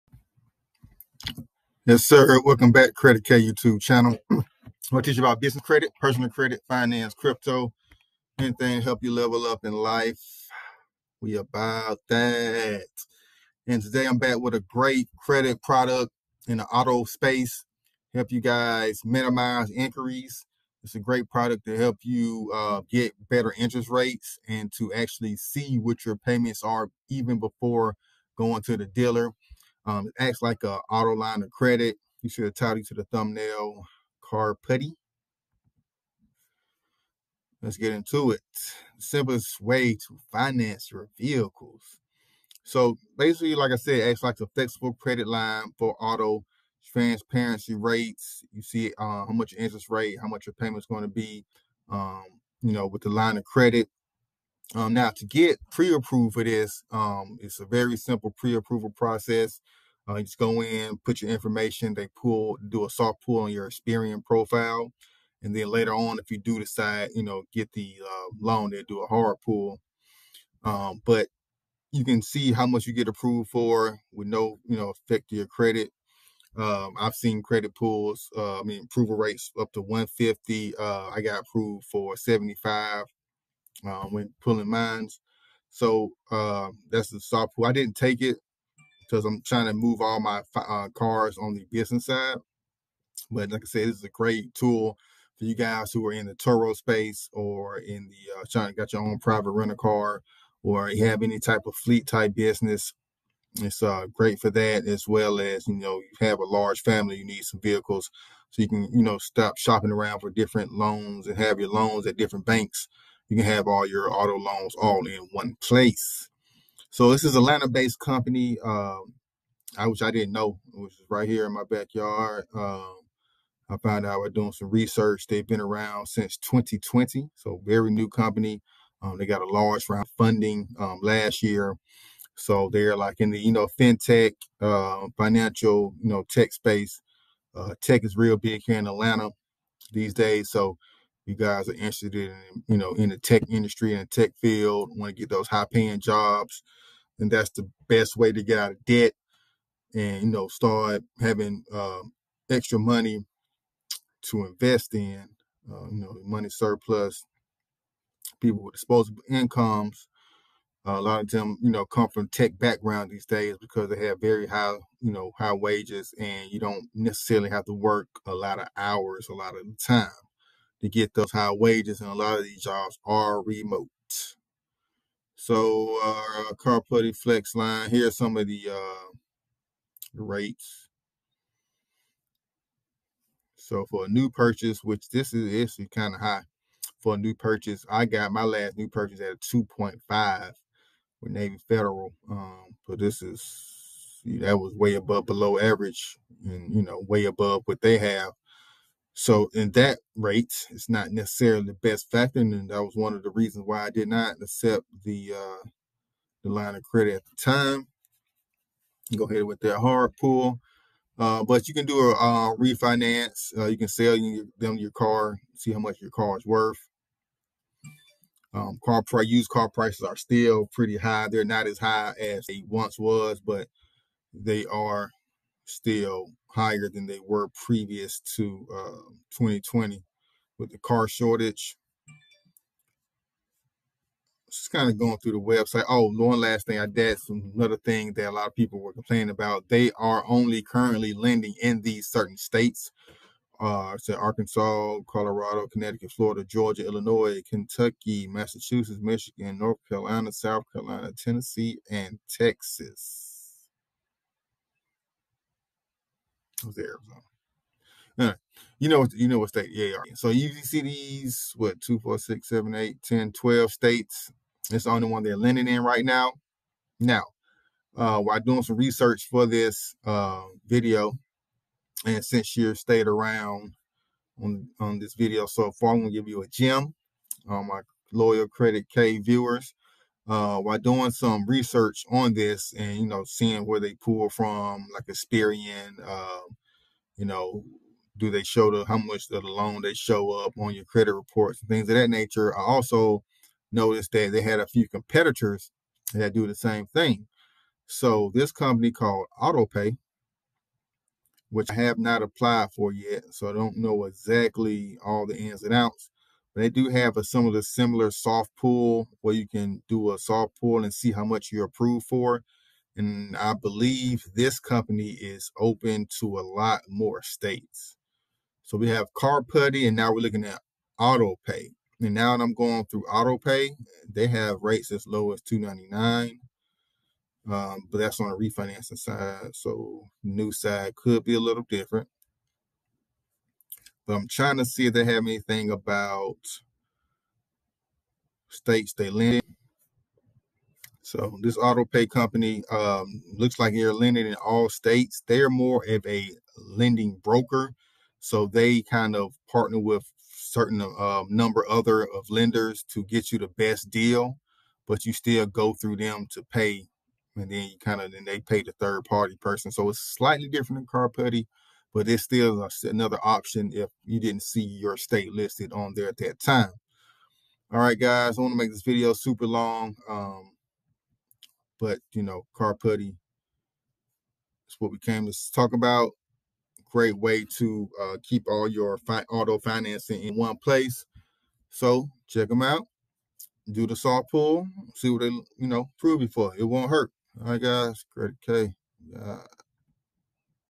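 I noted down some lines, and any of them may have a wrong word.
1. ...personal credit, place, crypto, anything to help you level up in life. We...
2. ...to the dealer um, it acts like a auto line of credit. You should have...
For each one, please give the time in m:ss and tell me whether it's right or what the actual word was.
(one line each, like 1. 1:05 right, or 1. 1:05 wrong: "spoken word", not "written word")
1. 0:05 wrong: "finance", not "place"
2. 0:28 right.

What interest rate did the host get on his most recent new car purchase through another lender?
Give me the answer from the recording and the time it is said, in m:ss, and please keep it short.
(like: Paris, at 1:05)
2.5, at 3:09.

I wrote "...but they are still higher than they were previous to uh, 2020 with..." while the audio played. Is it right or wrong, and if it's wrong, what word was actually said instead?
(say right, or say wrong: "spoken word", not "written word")
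right.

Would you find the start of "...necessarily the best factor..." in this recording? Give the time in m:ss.
3:21.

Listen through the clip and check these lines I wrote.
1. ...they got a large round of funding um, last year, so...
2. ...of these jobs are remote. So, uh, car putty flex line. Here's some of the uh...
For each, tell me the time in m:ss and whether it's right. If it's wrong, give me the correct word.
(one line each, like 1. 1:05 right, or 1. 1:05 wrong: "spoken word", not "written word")
1. 2:09 right
2. 2:52 right.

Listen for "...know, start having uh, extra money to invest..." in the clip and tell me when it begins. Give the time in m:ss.
2:30.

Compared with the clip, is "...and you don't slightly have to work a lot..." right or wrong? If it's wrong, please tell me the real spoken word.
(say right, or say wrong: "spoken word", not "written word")
wrong: "necessarily", not "slightly".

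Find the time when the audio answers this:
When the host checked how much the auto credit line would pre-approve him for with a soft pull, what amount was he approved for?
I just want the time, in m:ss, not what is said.
1:22.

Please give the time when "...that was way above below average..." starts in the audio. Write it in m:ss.
3:14.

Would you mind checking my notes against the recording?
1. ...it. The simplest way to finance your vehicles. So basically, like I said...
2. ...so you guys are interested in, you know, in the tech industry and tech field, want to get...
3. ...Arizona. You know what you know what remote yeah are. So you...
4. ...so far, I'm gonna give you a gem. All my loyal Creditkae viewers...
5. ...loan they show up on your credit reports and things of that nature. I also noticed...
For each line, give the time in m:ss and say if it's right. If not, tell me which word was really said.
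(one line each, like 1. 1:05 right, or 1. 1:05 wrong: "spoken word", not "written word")
1. 0:38 right
2. 2:20 right
3. 4:16 wrong: "state", not "remote"
4. 4:35 right
5. 4:49 right.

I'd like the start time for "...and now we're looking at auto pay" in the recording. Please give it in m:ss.
5:19.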